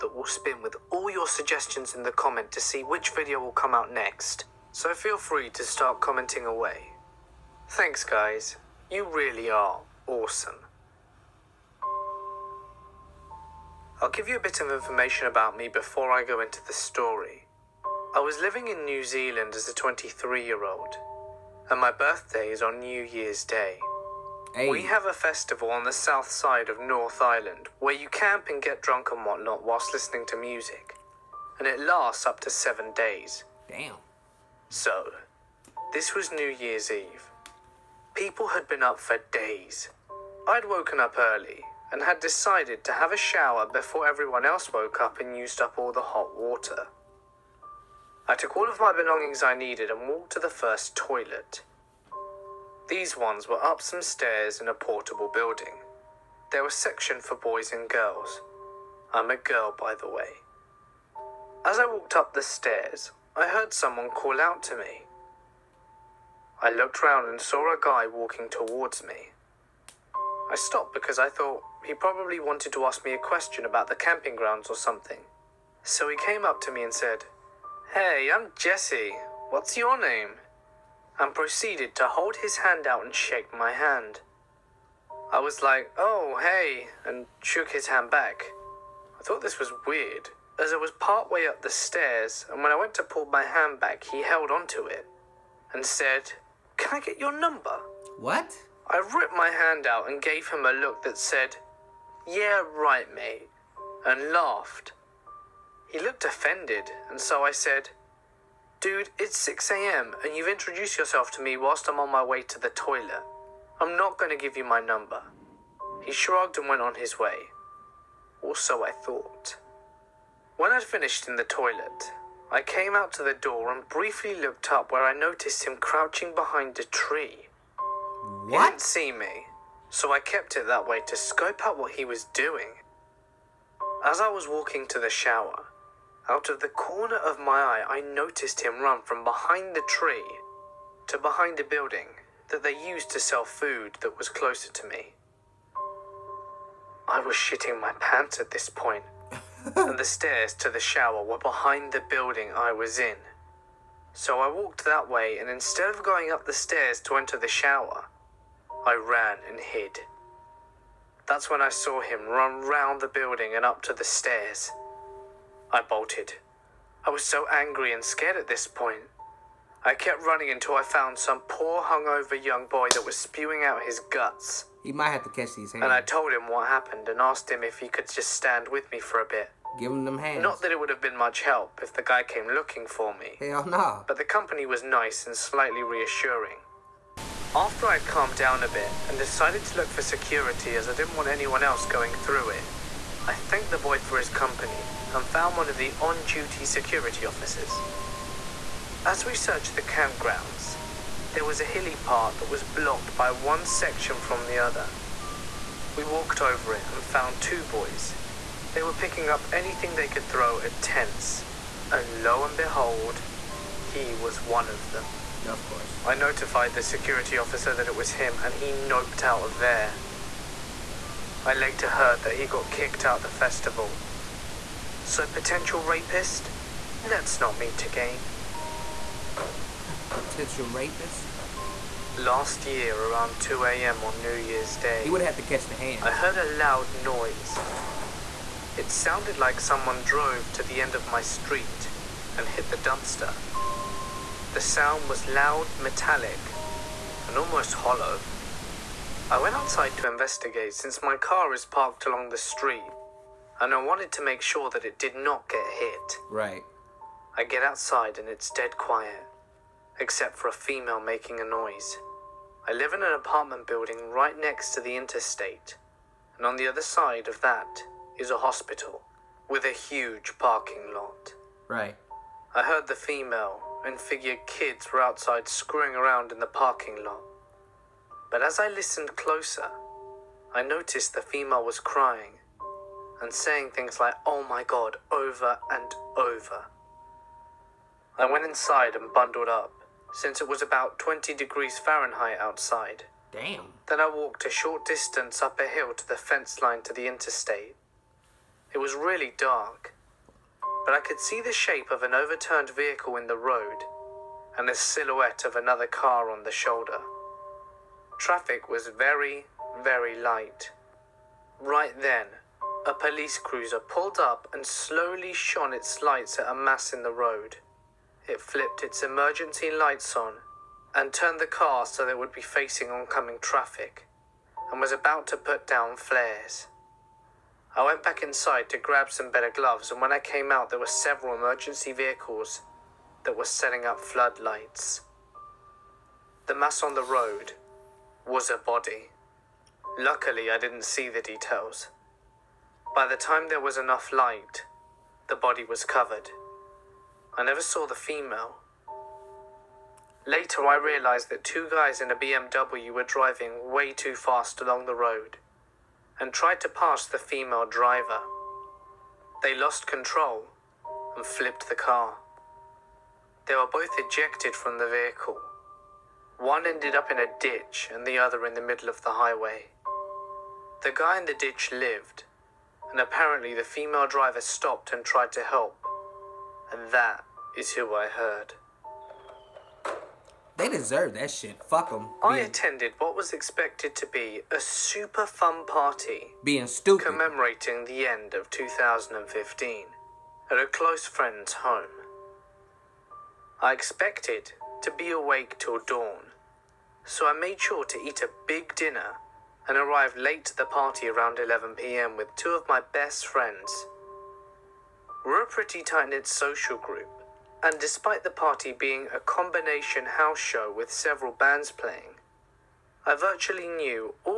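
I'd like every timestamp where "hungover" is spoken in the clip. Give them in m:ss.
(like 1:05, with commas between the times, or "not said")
2:51.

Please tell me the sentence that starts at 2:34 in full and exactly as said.
So I walked that way, and instead of going up the stairs to enter the shower, I ran and hid.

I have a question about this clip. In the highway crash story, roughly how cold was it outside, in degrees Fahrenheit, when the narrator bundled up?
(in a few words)
20.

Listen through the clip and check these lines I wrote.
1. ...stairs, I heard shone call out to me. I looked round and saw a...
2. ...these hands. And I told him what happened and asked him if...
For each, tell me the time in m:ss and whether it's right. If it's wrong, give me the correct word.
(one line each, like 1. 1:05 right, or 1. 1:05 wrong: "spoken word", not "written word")
1. 1:02 wrong: "someone", not "shone"
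2. 2:55 right.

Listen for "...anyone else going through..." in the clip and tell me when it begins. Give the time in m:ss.
3:11.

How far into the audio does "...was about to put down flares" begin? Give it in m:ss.
5:24.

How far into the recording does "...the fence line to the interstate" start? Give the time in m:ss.
4:56.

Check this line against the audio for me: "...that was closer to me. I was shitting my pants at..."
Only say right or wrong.
right.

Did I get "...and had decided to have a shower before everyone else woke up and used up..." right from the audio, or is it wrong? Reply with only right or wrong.
right.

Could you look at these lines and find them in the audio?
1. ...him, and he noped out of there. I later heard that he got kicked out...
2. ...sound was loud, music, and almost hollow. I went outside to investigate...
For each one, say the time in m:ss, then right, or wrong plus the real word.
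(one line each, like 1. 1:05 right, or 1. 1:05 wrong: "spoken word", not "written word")
1. 3:38 right
2. 4:04 wrong: "metallic", not "music".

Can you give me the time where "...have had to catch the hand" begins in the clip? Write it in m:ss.
3:55.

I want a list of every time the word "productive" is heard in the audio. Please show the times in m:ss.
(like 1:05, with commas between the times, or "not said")
not said.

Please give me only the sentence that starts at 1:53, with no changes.
I'm not going to give you my number.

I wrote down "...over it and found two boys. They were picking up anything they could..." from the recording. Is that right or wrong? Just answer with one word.
right.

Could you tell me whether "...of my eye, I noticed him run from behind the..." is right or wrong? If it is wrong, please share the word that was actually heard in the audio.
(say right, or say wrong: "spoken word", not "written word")
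right.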